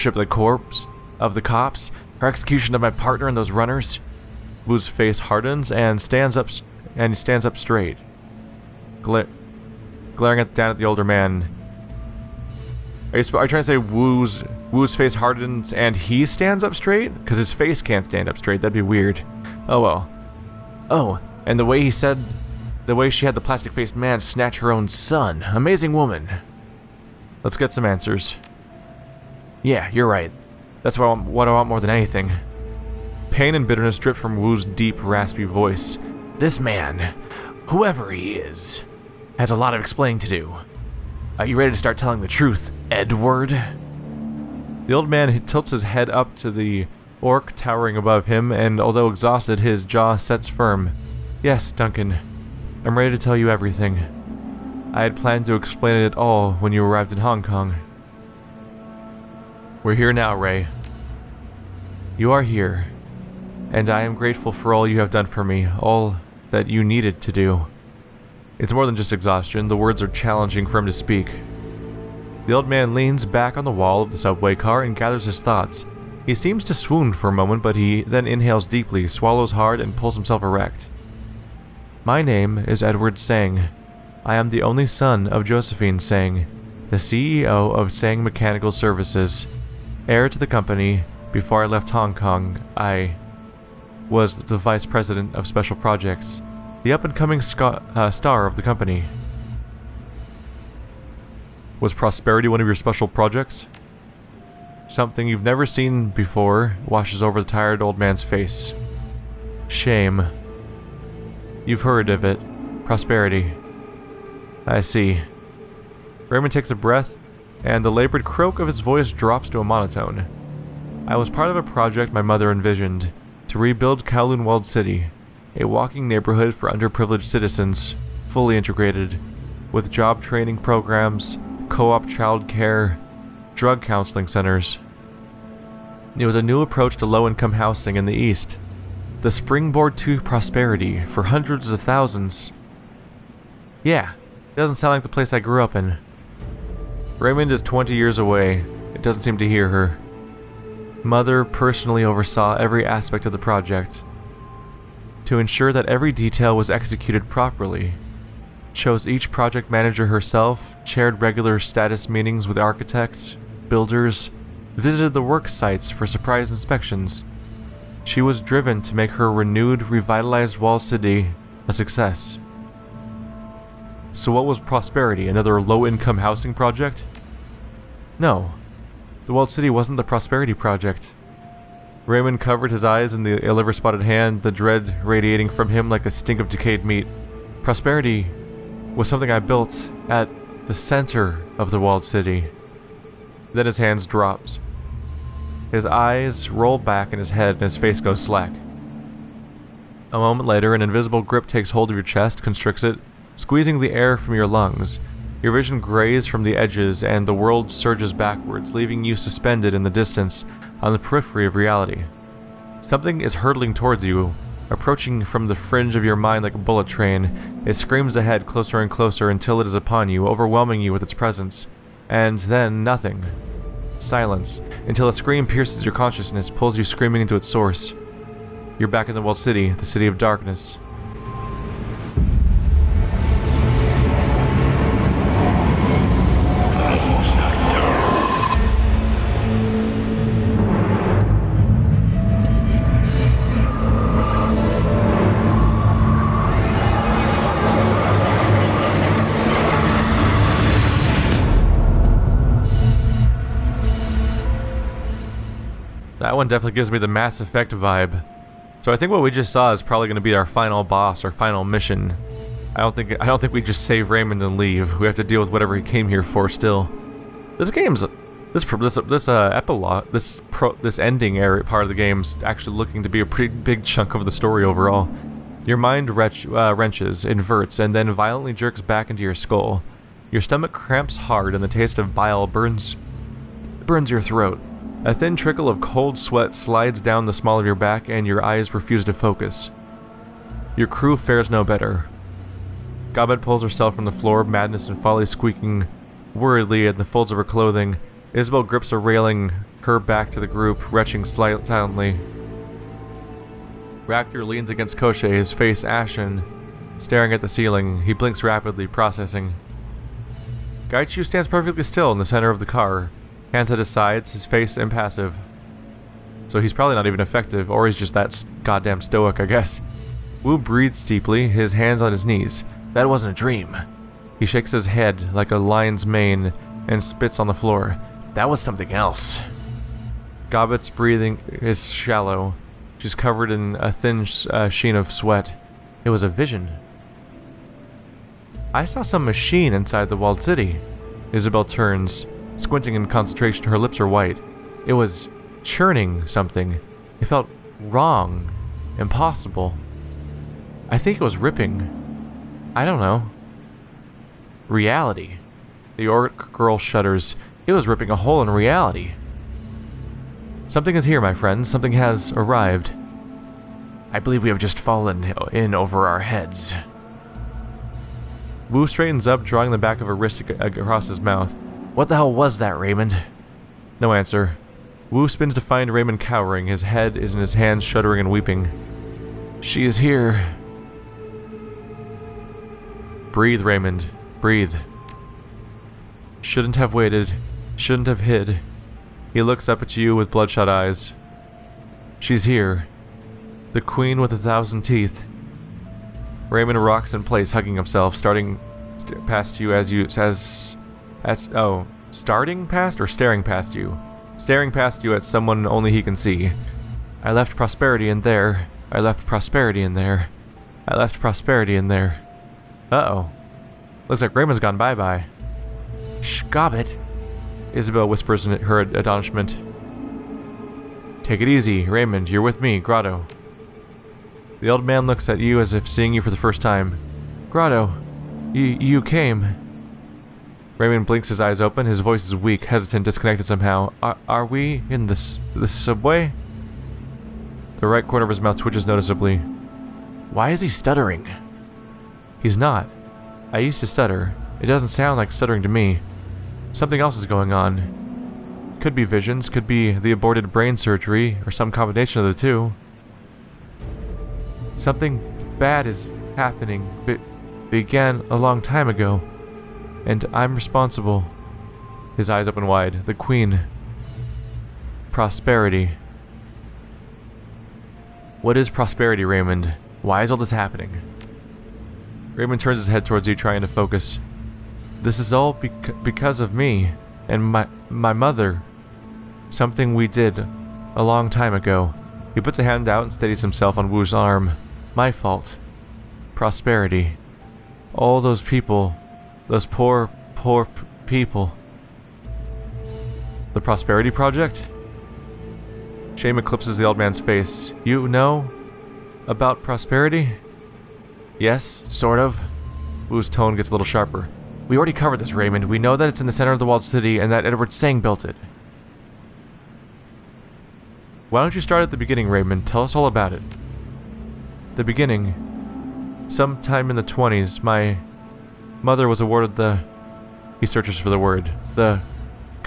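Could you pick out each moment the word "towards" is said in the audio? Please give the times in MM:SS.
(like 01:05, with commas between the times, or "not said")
03:33, 07:53.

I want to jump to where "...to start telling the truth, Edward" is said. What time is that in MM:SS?
00:41.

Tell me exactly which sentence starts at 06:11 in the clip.
What the hell was that, Raymond?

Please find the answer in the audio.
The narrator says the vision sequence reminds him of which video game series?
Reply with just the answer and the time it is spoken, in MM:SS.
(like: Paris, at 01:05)
Mass Effect, at 04:17.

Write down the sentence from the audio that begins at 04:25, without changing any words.
We have to deal with whatever he came here for still.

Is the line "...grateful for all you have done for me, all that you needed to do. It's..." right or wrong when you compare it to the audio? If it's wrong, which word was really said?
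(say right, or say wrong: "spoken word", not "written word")
right.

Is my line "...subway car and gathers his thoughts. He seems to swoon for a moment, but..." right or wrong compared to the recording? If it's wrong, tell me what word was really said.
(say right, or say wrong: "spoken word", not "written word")
right.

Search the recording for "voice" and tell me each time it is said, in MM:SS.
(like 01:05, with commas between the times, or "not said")
00:35, 01:58, 07:11.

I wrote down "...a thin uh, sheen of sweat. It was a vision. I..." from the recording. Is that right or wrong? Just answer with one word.
right.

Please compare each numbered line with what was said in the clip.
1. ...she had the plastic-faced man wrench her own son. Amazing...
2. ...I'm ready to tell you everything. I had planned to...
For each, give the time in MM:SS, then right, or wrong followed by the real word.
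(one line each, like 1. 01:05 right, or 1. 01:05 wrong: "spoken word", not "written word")
1. 00:23 wrong: "snatch", not "wrench"
2. 00:52 right.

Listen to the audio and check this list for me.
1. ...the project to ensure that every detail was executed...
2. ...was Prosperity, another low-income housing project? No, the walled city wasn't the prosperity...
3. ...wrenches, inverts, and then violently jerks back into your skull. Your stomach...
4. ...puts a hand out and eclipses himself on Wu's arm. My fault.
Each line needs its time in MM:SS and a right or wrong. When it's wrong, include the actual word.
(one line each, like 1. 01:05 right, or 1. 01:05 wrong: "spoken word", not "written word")
1. 02:33 right
2. 02:54 right
3. 04:36 right
4. 08:02 wrong: "steadies", not "eclipses".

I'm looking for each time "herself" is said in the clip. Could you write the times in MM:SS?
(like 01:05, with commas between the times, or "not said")
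02:40, 04:53.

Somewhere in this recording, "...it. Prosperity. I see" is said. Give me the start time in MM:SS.
01:52.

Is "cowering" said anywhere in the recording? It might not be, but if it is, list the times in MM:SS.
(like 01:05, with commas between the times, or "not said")
06:16.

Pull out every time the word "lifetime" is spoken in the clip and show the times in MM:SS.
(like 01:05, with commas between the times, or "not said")
not said.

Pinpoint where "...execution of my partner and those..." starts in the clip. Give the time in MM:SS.
00:02.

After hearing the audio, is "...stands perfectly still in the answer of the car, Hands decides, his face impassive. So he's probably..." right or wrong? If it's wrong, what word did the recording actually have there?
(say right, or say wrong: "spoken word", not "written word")
wrong: "center", not "answer".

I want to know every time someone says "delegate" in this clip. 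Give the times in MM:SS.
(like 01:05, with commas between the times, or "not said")
not said.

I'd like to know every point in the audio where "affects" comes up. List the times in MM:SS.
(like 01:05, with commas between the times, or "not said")
not said.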